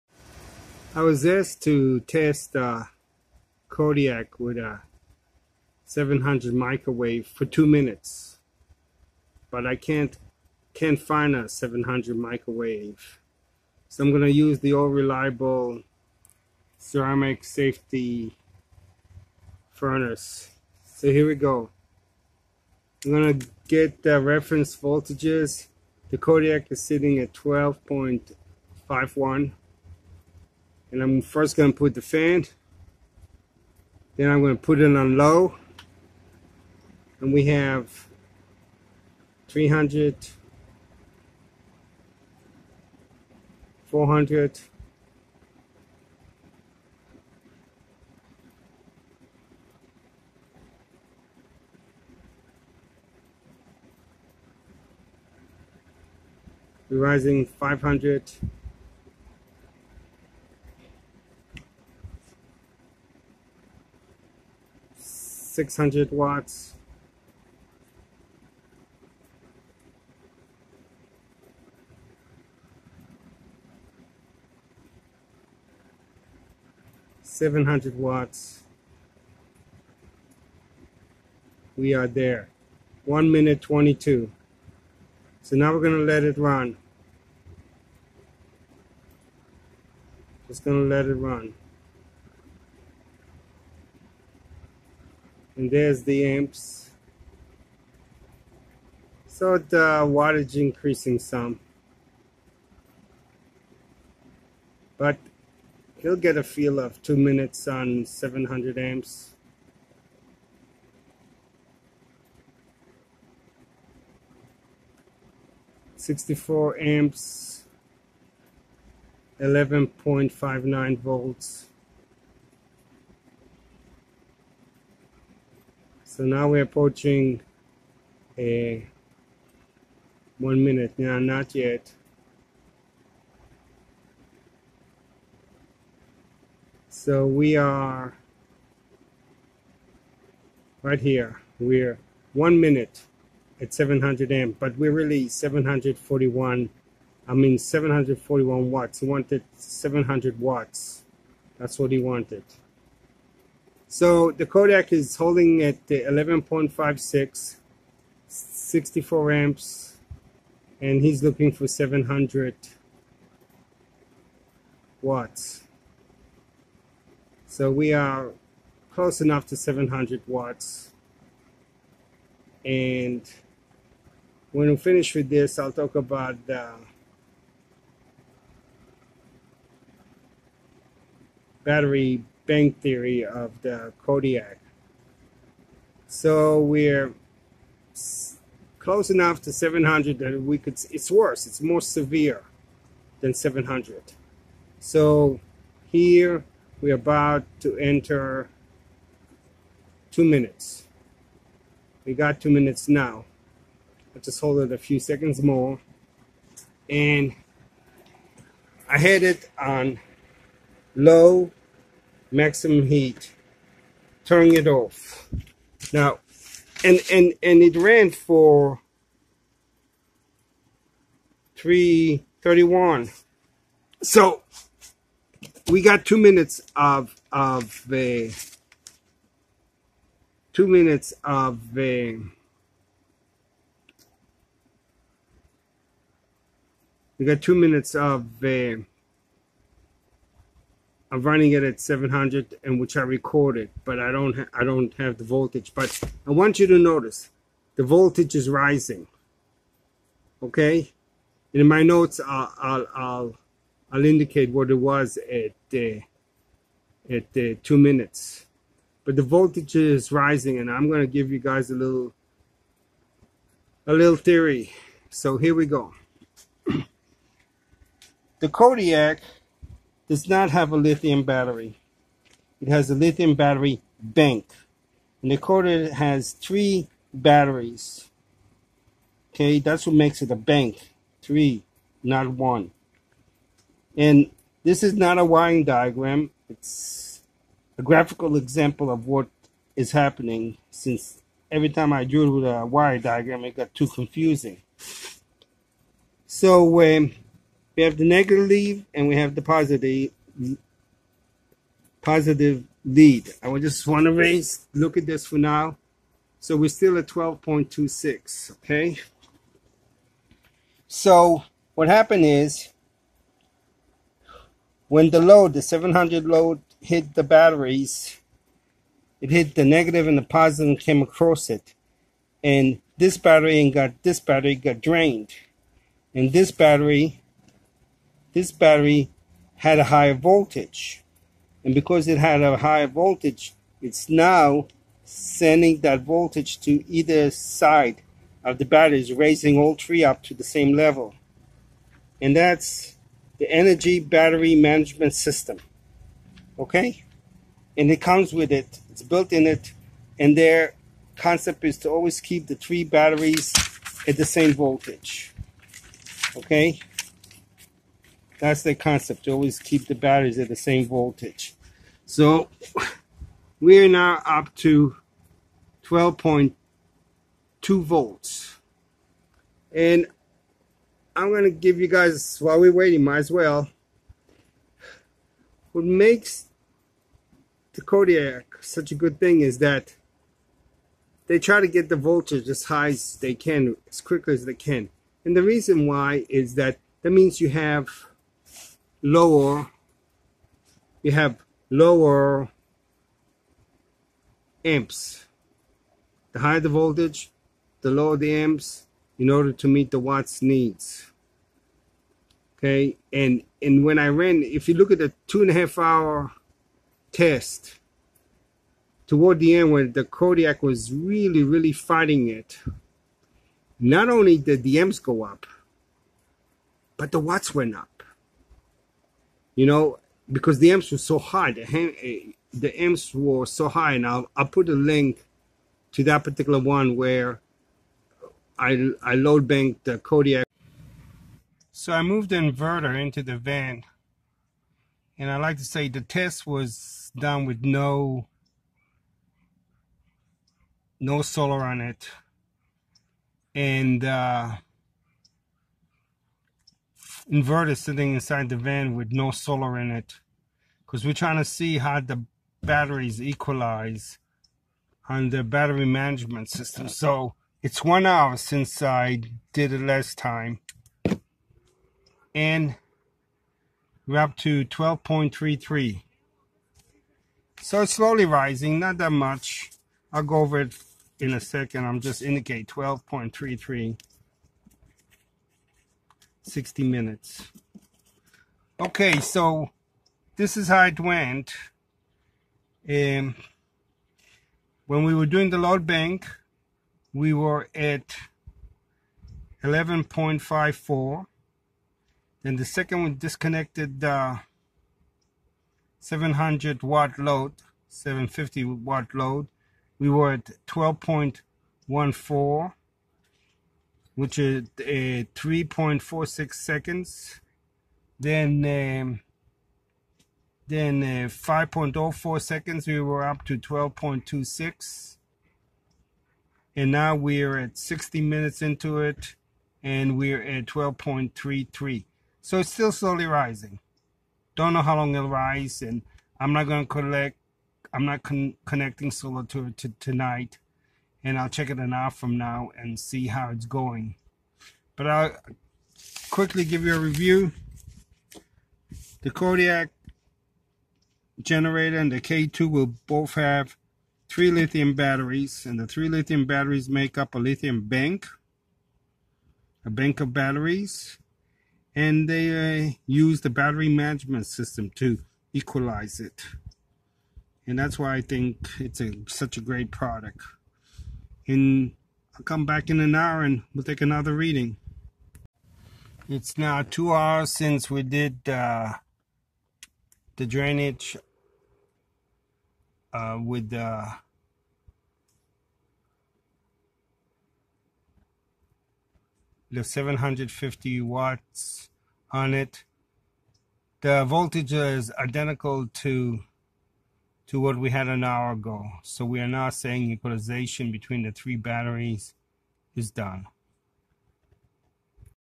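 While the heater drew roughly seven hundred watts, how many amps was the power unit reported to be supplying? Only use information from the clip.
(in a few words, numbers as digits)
64.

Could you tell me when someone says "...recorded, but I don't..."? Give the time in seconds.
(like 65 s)
243 s.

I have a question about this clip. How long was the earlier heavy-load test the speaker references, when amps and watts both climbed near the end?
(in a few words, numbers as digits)
2.5 hours.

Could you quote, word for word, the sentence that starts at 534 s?
But I'll quickly give you a review.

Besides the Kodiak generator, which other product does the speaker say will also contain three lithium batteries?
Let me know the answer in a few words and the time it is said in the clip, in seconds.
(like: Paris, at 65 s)
K2, at 542 s.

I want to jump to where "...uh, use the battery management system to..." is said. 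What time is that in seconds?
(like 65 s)
552 s.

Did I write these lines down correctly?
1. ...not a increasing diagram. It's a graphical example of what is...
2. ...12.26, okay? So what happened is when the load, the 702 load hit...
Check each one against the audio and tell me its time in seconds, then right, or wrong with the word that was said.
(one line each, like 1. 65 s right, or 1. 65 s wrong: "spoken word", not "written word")
1. 284 s wrong: "wiring", not "increasing"
2. 307 s wrong: "700", not "702".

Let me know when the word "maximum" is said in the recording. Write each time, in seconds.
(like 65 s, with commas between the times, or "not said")
212 s.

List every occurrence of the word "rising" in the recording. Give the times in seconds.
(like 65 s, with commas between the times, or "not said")
56 s, 248 s, 260 s, 468 s, 523 s.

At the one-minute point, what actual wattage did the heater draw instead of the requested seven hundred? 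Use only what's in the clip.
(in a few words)
741 watts.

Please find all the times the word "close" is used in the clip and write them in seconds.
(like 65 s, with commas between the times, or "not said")
168 s, 188 s.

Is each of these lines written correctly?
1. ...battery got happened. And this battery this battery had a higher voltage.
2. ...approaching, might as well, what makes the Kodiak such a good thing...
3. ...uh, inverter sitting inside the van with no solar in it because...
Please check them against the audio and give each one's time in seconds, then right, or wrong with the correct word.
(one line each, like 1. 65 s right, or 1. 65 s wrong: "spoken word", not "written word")
1. 324 s wrong: "drained", not "happened"
2. 372 s wrong: "waiting", not "approaching"
3. 444 s right.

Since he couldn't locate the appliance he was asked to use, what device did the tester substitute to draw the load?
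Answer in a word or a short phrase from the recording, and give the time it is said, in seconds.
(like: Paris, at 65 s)
ceramic safety furnace, at 16 s.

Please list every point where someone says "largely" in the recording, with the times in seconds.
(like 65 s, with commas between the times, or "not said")
not said.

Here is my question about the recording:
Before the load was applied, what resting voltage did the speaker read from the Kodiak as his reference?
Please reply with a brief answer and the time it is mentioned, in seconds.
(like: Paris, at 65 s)
12.51, at 27 s.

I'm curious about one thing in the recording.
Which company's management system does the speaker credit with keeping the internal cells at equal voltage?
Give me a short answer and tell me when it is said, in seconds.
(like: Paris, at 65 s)
Inergy, at 343 s.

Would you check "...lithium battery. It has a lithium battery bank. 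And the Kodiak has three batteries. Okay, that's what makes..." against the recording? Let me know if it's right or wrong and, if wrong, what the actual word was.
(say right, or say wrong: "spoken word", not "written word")
right.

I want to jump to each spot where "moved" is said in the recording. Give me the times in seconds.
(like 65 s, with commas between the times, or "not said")
432 s.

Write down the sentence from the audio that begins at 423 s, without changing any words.
And I'll, I'll put a link to that particular one where I, I load banked the Kodiak.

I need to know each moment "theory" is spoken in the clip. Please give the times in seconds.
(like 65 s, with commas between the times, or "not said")
182 s, 264 s.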